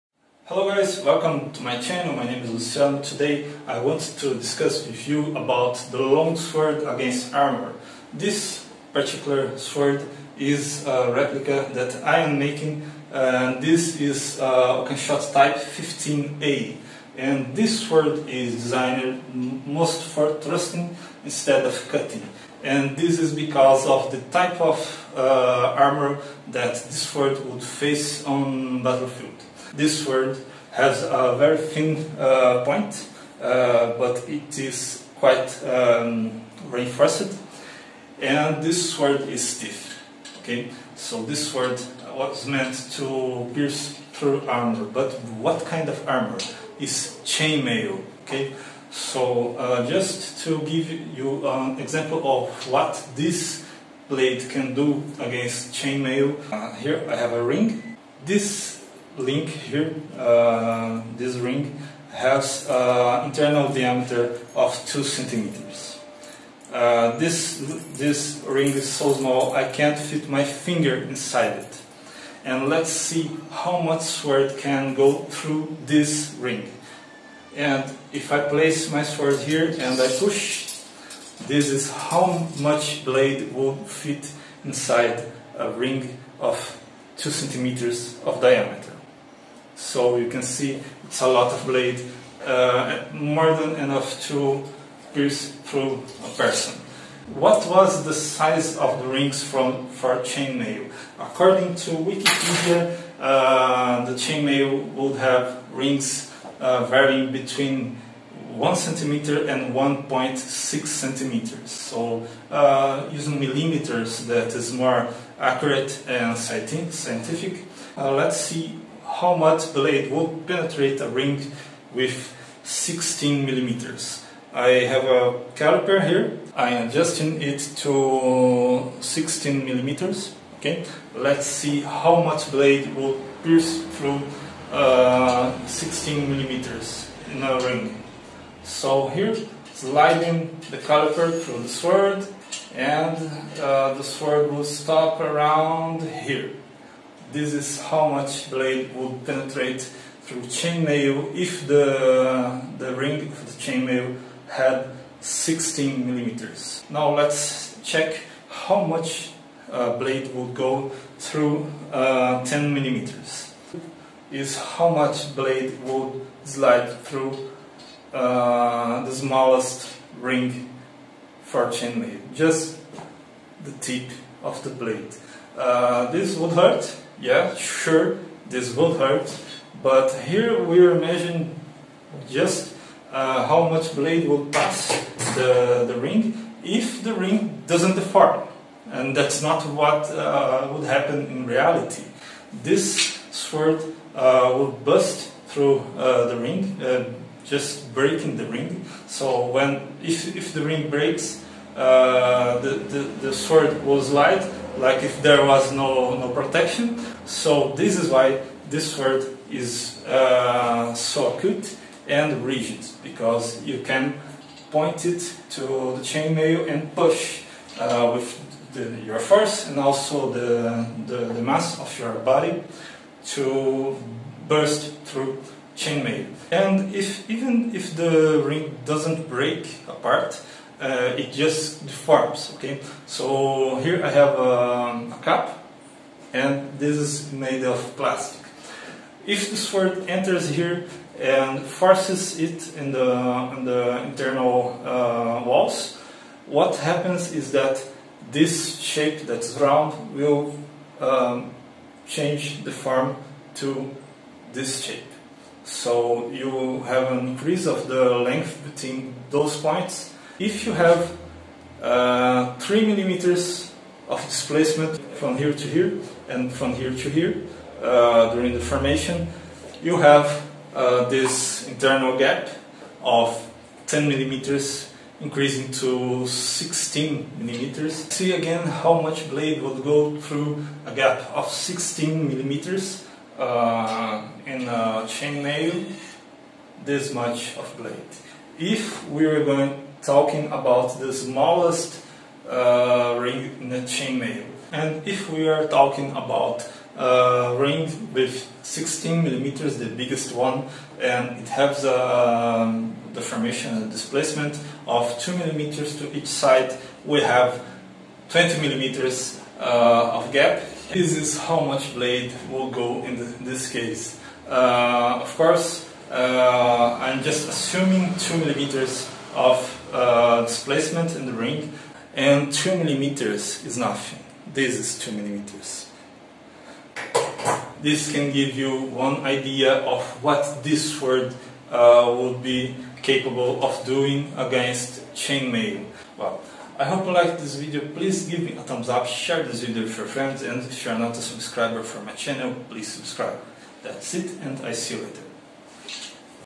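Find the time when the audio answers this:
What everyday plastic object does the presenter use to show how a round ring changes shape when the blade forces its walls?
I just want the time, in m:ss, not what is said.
3:55.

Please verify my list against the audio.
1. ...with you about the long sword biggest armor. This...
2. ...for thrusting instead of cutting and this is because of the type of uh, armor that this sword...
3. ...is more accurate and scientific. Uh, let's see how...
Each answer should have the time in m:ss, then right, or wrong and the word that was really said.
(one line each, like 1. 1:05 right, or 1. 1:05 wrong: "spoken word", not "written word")
1. 0:04 wrong: "against", not "biggest"
2. 0:20 right
3. 1:54 right.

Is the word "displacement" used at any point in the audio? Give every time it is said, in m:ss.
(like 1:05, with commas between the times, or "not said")
4:24, 5:03, 5:20.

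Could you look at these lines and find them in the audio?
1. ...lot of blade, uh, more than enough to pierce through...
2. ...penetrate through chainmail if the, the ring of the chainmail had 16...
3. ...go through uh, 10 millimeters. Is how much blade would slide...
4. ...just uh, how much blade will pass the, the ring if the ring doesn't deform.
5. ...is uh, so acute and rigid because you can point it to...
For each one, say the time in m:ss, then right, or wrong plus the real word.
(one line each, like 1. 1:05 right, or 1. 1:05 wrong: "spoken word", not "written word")
1. 1:31 right
2. 2:29 right
3. 2:40 right
4. 3:02 right
5. 3:29 right.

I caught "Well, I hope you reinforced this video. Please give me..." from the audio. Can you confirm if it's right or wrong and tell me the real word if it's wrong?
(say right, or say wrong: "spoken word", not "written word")
wrong: "liked", not "reinforced".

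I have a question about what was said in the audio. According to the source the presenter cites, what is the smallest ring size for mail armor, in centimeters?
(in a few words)
1 centimeter.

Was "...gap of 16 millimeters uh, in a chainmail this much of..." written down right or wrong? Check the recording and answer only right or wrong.
right.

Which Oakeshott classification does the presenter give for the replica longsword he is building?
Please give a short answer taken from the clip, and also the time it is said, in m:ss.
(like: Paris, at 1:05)
Type 15A, at 0:15.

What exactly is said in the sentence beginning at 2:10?
Okay, let's see how much blade will pierce through uh, 16 millimeters in a ring.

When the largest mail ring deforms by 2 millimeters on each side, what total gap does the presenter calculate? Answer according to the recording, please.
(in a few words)
20 millimeters.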